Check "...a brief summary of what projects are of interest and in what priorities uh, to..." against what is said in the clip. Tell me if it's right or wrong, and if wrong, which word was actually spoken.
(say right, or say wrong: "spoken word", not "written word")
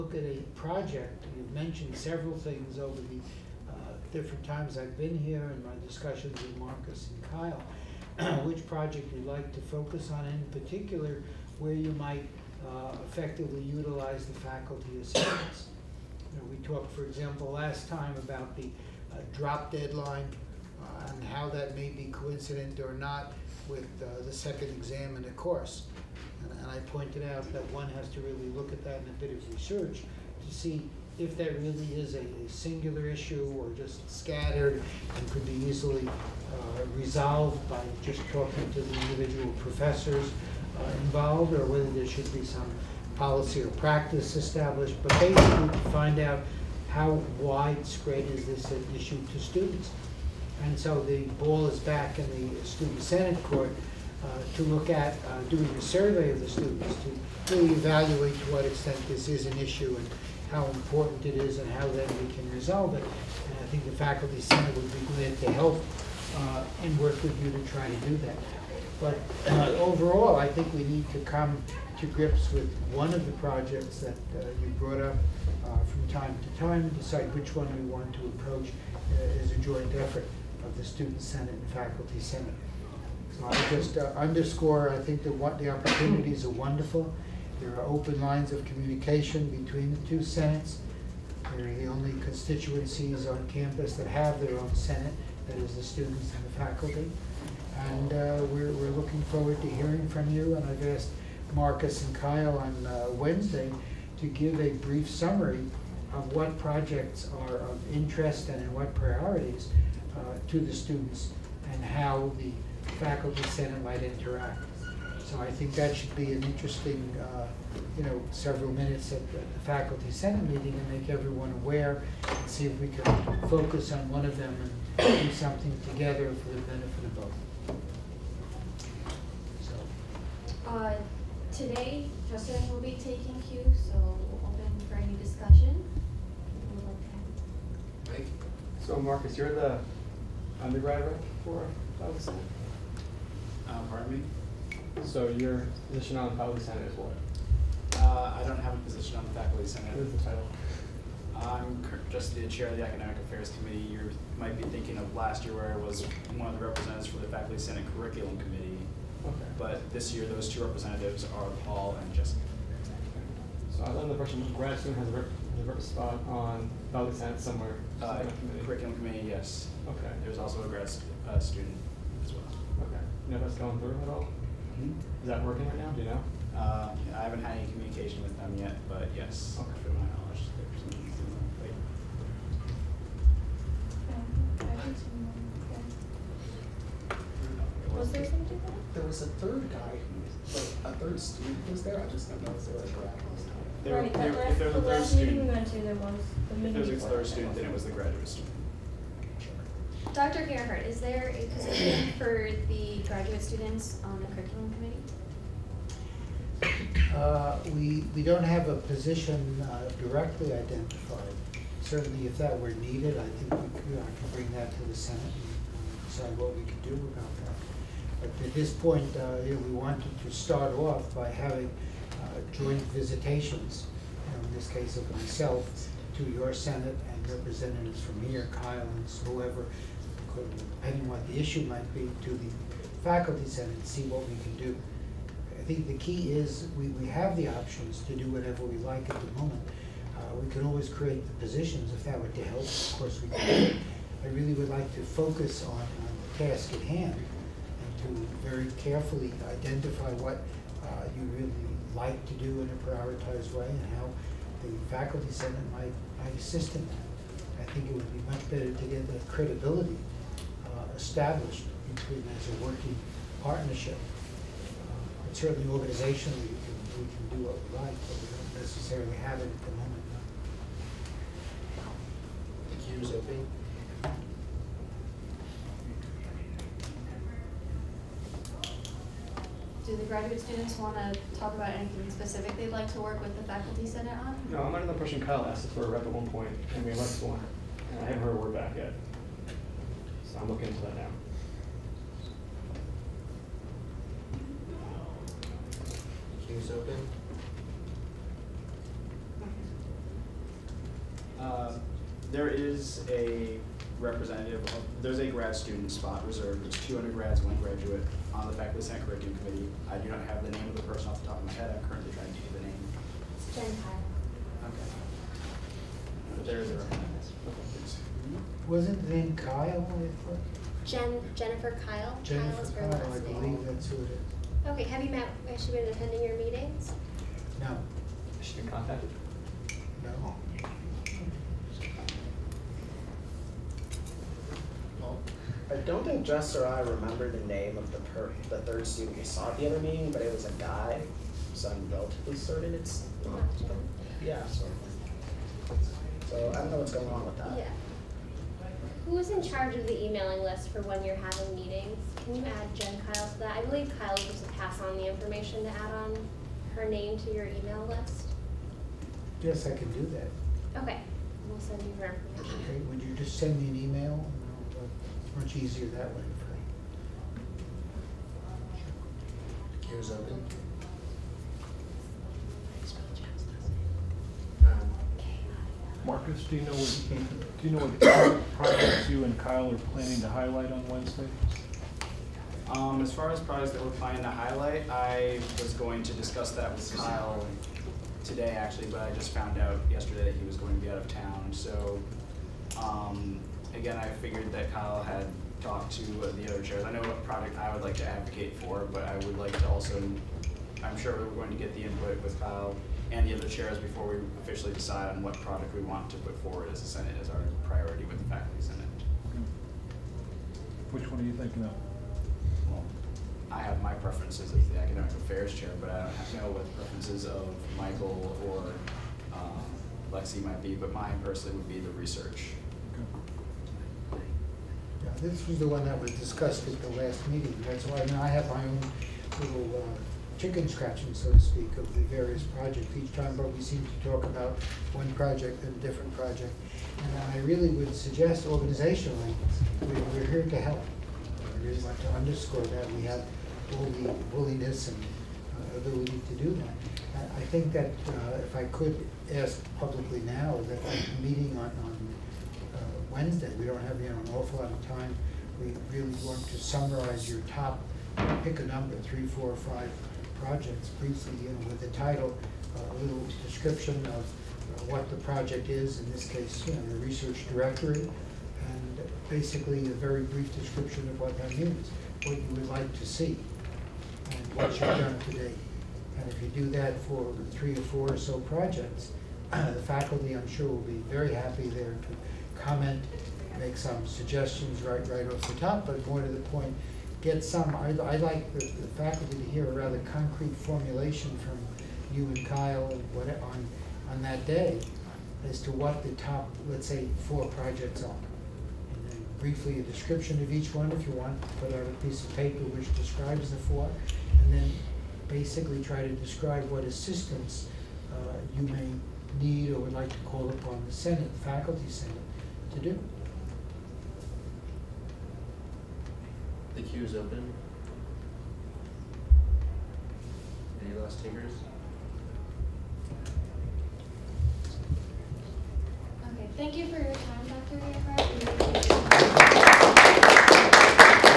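right.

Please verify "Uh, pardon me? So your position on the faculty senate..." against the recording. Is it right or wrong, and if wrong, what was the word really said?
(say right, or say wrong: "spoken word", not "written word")
right.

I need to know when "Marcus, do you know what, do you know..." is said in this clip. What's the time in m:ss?
6:16.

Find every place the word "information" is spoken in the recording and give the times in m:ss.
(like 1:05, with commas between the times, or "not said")
5:55, 6:02.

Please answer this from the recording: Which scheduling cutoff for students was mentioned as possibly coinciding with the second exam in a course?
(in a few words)
Drop deadline.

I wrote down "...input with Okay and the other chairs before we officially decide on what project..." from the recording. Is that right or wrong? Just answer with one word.
wrong.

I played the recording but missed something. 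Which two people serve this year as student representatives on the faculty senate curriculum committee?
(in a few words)
Paul and Jessica.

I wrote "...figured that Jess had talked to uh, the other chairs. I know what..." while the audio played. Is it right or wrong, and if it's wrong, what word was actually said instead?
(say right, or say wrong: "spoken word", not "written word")
wrong: "Kyle", not "Jess".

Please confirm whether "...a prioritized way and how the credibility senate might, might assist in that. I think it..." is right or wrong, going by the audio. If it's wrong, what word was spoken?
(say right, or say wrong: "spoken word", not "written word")
wrong: "faculty", not "credibility".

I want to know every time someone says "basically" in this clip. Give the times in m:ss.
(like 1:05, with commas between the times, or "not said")
0:45, 7:49, 8:25.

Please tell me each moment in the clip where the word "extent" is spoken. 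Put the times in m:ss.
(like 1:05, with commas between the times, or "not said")
0:58.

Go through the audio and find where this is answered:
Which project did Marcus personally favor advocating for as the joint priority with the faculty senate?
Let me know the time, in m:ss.
7:47.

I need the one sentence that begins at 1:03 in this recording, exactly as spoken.
And I think the Faculty Senate would be glad to help uh, and work with you to try to do that.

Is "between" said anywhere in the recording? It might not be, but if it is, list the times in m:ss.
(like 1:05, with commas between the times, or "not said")
1:29, 4:21.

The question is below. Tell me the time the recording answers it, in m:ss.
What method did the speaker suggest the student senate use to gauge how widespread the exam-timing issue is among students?
0:55.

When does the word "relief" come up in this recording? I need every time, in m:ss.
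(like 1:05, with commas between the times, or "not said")
not said.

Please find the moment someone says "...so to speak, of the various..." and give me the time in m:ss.
7:11.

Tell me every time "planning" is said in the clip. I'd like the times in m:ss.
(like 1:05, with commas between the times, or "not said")
6:19, 6:23.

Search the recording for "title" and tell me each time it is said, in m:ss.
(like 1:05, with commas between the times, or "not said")
2:30, 7:41.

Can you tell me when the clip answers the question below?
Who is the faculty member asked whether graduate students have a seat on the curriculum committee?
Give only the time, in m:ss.
3:20.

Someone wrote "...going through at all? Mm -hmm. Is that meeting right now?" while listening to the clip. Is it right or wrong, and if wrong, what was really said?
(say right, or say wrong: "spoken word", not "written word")
wrong: "working", not "meeting".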